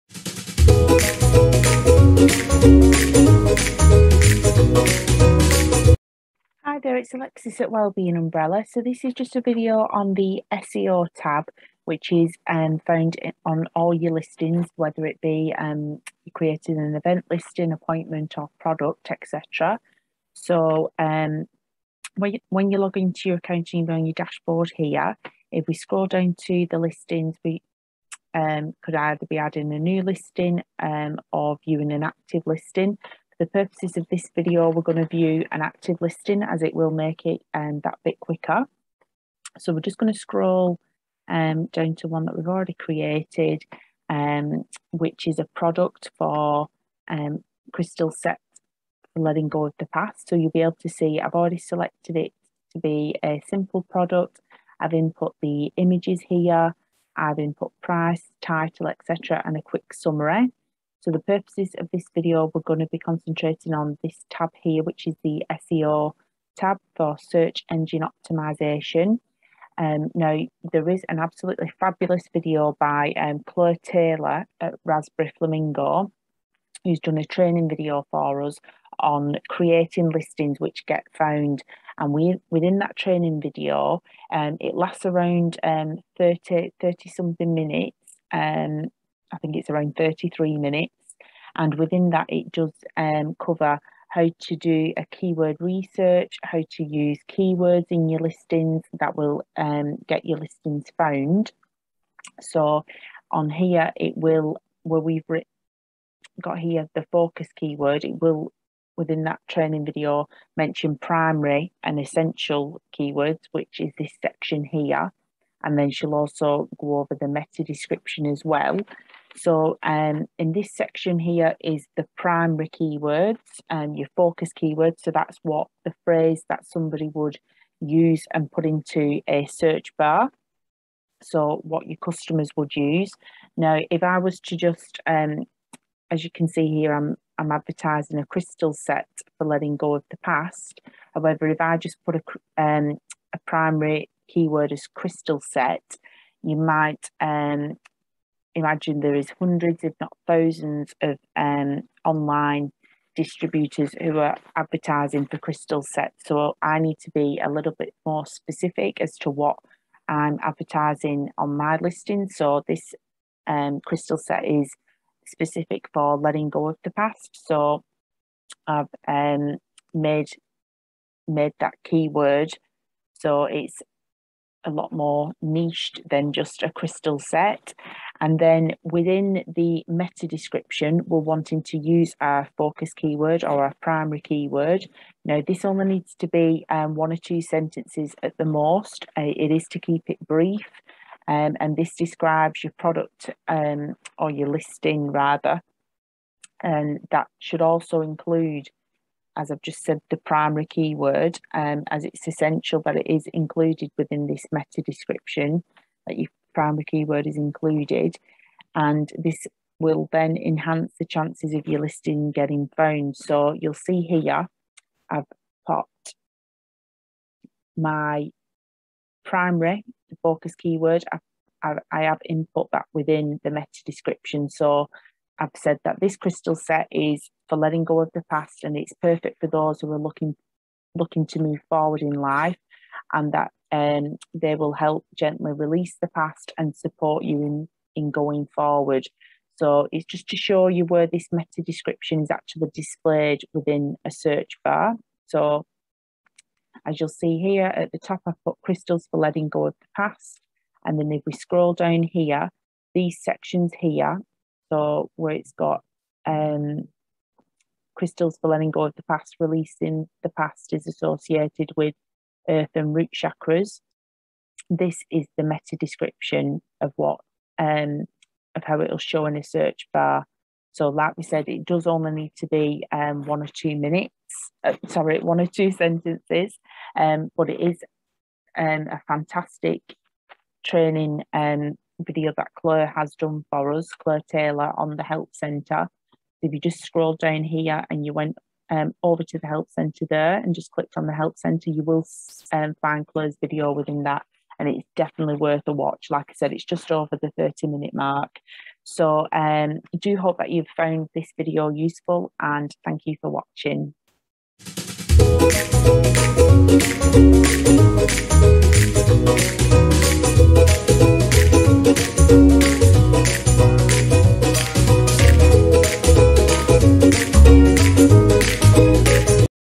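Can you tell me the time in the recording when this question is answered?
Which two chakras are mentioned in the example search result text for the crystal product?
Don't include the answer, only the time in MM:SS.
04:22.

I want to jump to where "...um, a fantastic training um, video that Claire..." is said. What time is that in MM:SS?
04:38.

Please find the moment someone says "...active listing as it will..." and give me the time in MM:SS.
00:35.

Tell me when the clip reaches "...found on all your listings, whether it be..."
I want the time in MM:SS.
00:12.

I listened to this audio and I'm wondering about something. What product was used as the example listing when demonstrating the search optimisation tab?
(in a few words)
Crystal set for letting go of the past.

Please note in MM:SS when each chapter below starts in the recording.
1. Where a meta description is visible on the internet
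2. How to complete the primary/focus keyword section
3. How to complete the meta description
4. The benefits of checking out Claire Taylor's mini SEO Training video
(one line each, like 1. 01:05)
1. 04:00
2. 02:00
3. 02:56
4. 01:10.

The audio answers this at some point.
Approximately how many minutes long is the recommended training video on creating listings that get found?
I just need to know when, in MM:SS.
01:29.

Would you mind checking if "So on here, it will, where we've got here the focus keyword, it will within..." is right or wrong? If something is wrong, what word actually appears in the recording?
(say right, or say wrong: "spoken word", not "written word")
right.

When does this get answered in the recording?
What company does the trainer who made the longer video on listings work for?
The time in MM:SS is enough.
01:14.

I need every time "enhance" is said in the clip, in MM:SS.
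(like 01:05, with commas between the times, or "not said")
03:30.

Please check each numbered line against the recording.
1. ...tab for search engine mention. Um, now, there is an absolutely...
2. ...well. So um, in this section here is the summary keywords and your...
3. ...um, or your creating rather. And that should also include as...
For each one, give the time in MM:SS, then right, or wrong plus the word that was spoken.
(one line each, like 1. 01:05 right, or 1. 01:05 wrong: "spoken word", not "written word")
1. 01:06 wrong: "optimization", not "mention"
2. 01:58 wrong: "primary", not "summary"
3. 03:13 wrong: "listing", not "creating".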